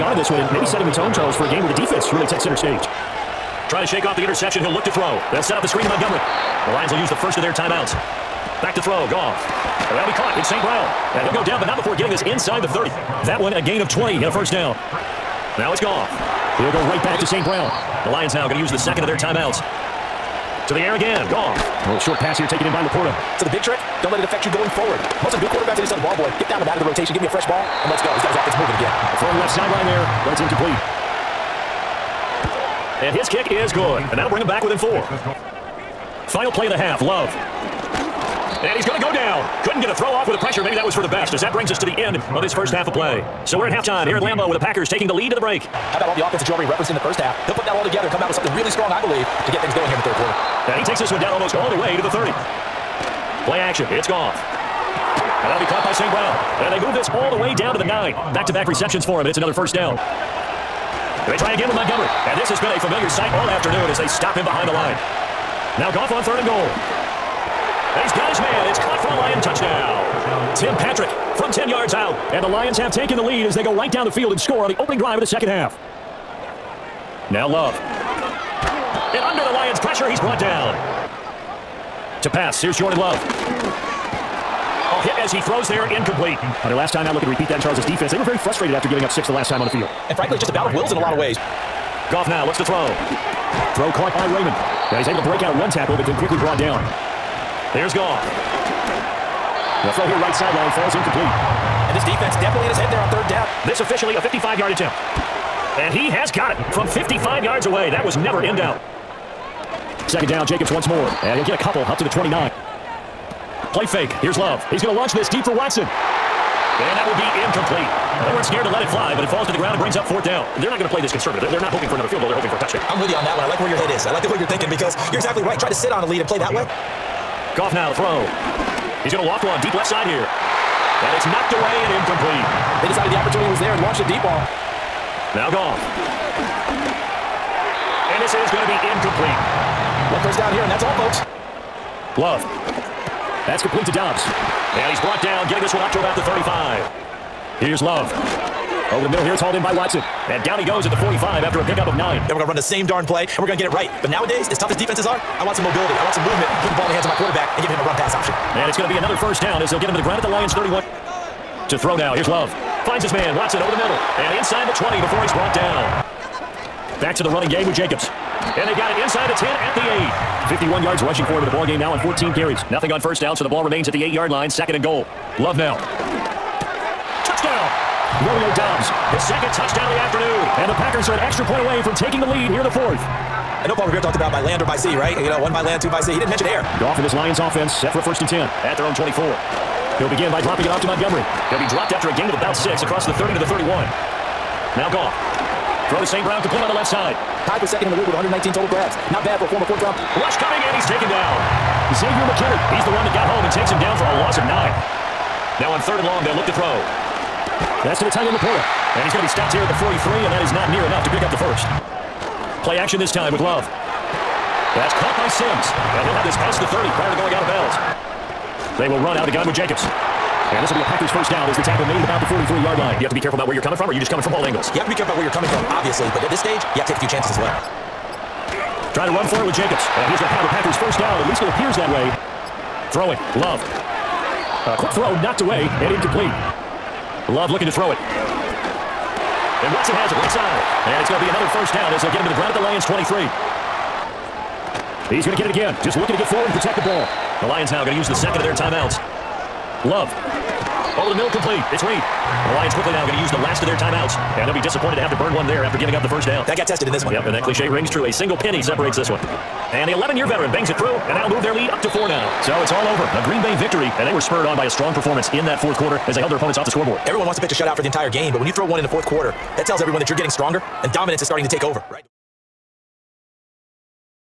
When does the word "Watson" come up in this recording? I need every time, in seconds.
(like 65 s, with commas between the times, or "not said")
115 s, 149 s, 163 s, 239 s.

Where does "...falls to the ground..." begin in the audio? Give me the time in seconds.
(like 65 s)
119 s.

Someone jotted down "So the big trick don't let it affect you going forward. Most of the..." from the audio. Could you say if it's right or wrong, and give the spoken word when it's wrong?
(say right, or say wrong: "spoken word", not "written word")
right.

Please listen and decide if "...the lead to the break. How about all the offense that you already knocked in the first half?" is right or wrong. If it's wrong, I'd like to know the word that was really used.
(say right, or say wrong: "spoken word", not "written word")
wrong: "referenced", not "knocked".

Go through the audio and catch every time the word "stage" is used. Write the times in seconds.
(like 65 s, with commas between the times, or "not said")
2 s, 226 s.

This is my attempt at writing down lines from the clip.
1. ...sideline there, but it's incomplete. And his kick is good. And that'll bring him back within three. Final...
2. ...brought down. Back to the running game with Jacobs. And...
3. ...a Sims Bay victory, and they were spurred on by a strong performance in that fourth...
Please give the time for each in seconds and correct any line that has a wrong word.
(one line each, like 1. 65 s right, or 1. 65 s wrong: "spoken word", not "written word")
1. 29 s wrong: "four", not "three"
2. 165 s right
3. 263 s wrong: "Green", not "Sims".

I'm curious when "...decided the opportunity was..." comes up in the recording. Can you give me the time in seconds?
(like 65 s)
132 s.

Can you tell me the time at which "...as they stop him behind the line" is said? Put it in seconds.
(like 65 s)
63 s.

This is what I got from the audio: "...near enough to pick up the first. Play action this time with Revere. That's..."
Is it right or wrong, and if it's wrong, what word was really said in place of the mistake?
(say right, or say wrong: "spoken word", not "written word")
wrong: "Love", not "Revere".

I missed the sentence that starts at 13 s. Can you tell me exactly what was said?
That one a gain of 20 and a first down.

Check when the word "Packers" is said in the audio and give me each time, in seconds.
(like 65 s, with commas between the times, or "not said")
44 s, 180 s, 220 s, 230 s.